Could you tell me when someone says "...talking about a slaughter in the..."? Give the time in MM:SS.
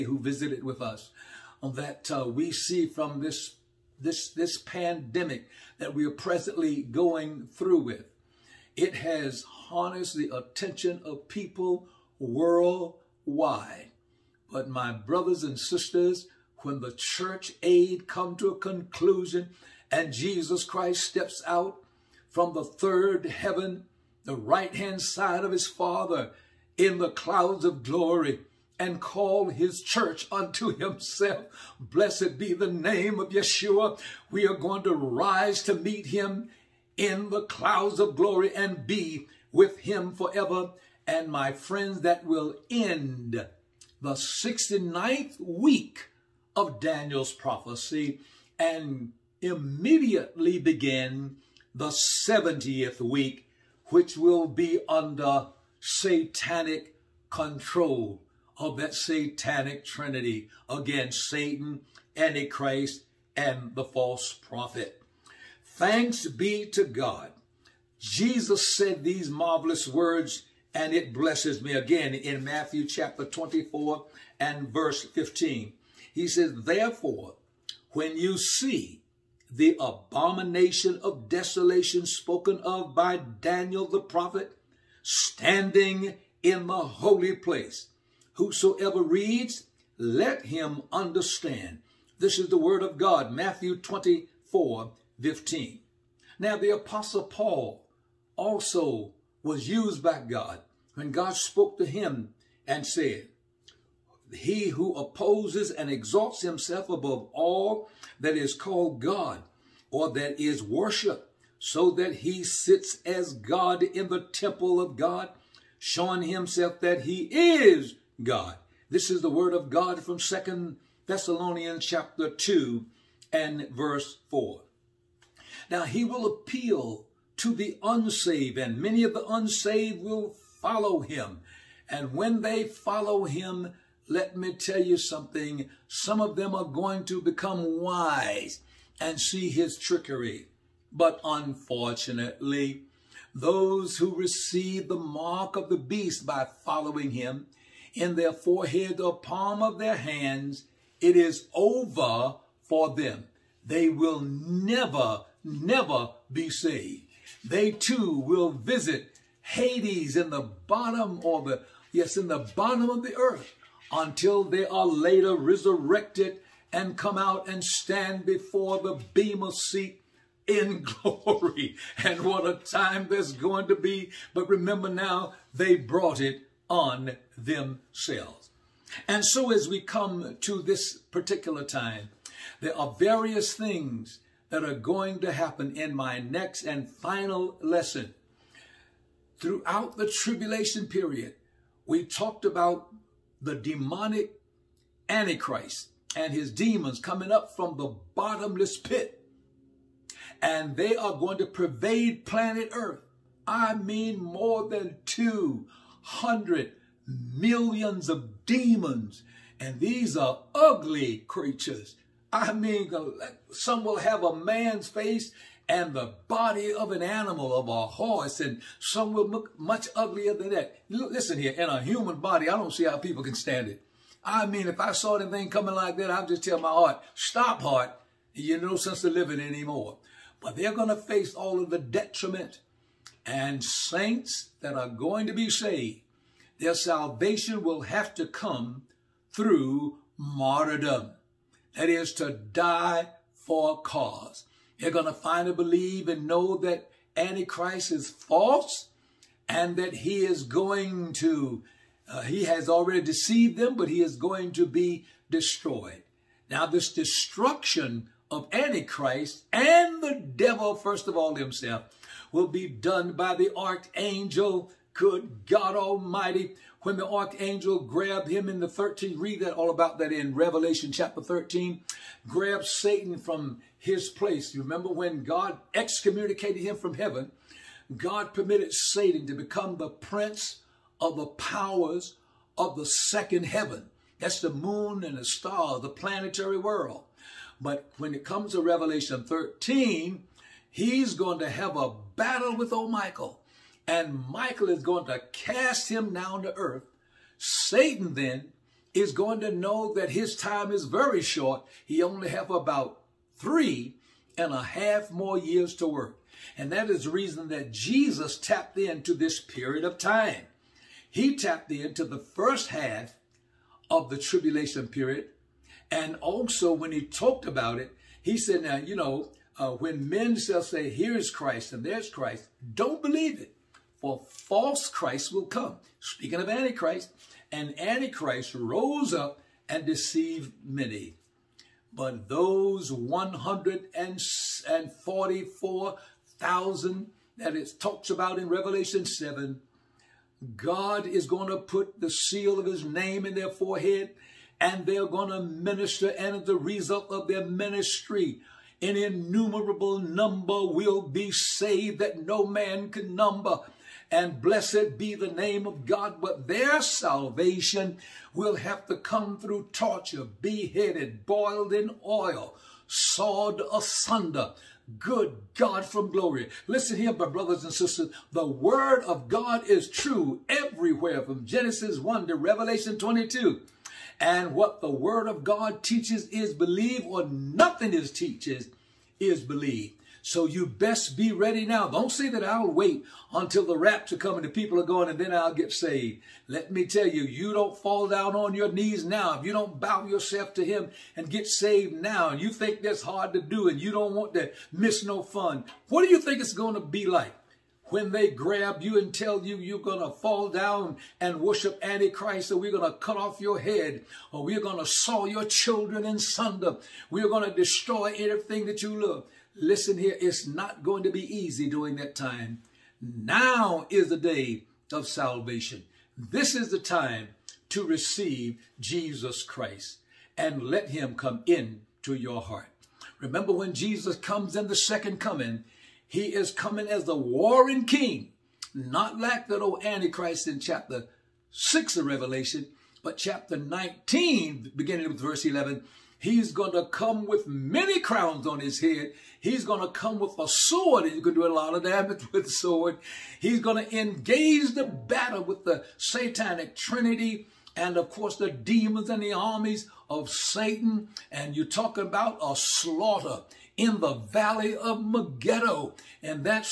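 07:31.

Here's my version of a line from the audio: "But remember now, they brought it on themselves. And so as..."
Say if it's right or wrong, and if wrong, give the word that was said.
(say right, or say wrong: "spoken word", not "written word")
right.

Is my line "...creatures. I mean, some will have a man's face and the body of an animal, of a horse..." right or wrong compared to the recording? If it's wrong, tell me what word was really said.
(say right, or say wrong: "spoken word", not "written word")
right.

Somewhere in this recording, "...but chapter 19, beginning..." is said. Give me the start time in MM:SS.
07:13.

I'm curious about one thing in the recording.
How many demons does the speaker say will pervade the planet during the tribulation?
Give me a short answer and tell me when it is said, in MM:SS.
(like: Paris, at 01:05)
200 million, at 03:25.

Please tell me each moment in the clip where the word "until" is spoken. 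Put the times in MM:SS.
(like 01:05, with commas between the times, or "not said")
02:43, 06:23.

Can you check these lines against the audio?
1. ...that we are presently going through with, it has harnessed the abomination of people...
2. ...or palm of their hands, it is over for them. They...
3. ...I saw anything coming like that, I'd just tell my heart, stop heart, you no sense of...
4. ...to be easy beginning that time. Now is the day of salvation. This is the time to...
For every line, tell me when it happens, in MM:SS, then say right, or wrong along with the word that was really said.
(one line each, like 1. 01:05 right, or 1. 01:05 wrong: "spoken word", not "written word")
1. 00:05 wrong: "attention", not "abomination"
2. 02:29 right
3. 03:44 right
4. 06:51 wrong: "during", not "beginning".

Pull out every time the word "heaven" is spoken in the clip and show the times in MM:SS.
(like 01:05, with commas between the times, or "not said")
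00:23, 04:36, 04:43.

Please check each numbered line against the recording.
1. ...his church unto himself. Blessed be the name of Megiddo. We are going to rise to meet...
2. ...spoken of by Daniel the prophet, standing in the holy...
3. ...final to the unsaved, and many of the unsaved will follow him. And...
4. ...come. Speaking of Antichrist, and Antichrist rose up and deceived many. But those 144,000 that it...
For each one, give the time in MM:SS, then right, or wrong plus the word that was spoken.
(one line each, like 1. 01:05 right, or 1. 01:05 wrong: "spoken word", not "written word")
1. 00:29 wrong: "Yeshua", not "Megiddo"
2. 01:22 right
3. 02:06 wrong: "appeal", not "final"
4. 05:25 right.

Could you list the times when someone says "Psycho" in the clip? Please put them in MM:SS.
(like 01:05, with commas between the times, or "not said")
not said.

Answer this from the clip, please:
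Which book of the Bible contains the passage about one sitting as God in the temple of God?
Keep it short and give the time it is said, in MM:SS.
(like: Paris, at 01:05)
Second Thessalonians, at 02:00.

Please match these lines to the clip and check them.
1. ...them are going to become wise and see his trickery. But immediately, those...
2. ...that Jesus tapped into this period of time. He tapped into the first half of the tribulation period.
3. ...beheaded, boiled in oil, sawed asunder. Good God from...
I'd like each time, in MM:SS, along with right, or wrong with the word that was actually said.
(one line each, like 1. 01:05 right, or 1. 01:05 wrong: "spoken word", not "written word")
1. 02:16 wrong: "unfortunately", not "immediately"
2. 05:07 right
3. 06:00 right.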